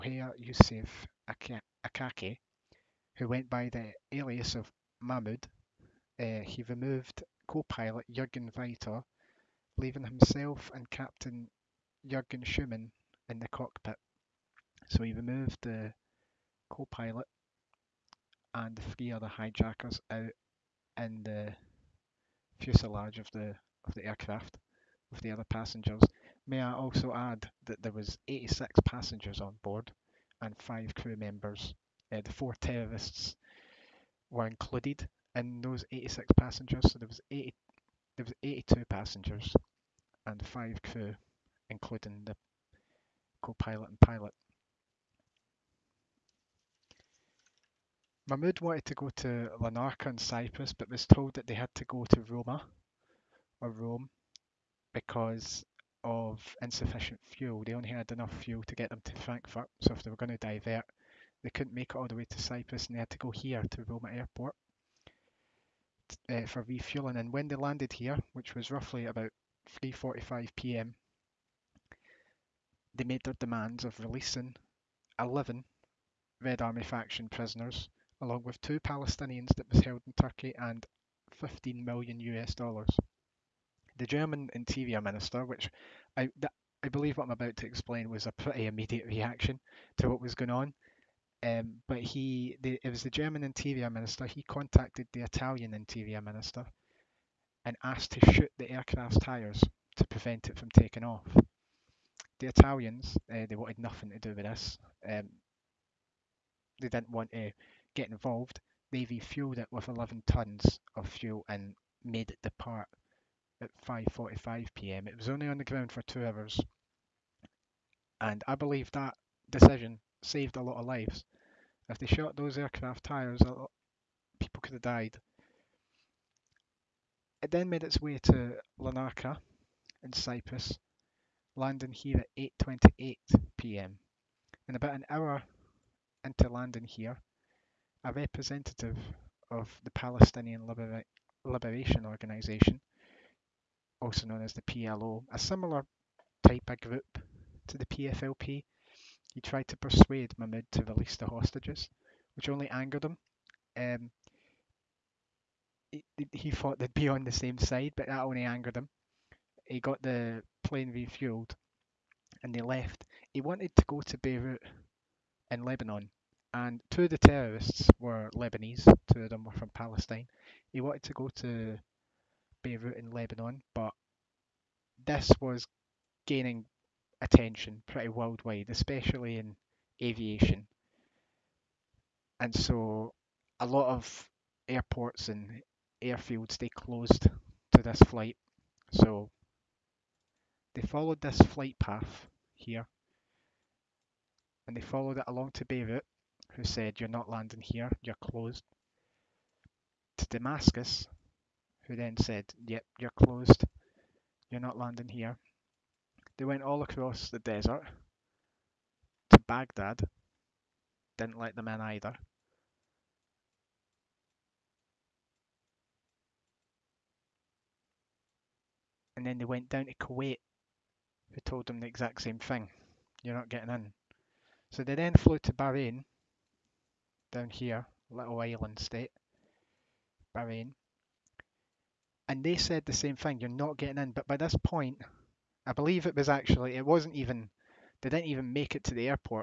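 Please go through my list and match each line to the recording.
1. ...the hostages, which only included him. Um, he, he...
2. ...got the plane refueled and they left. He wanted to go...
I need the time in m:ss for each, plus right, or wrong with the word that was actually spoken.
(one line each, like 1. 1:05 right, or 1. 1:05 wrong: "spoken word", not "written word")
1. 2:31 wrong: "angered", not "included"
2. 2:39 right.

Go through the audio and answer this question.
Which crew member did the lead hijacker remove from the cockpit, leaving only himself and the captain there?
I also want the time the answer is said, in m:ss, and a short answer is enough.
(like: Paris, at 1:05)
Jurgen Weiter, at 0:08.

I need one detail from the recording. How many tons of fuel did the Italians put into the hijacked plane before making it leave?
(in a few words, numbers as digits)
11.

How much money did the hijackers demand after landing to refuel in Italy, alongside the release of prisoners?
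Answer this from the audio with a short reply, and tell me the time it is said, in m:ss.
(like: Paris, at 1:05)
15 million US dollars, at 1:21.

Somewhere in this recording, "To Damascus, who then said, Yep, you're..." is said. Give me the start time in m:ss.
3:20.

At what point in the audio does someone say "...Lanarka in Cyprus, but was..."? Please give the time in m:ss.
0:49.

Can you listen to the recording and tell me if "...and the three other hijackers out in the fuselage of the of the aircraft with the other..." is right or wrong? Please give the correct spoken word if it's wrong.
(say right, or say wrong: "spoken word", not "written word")
right.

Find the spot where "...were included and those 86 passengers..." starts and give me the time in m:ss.
0:34.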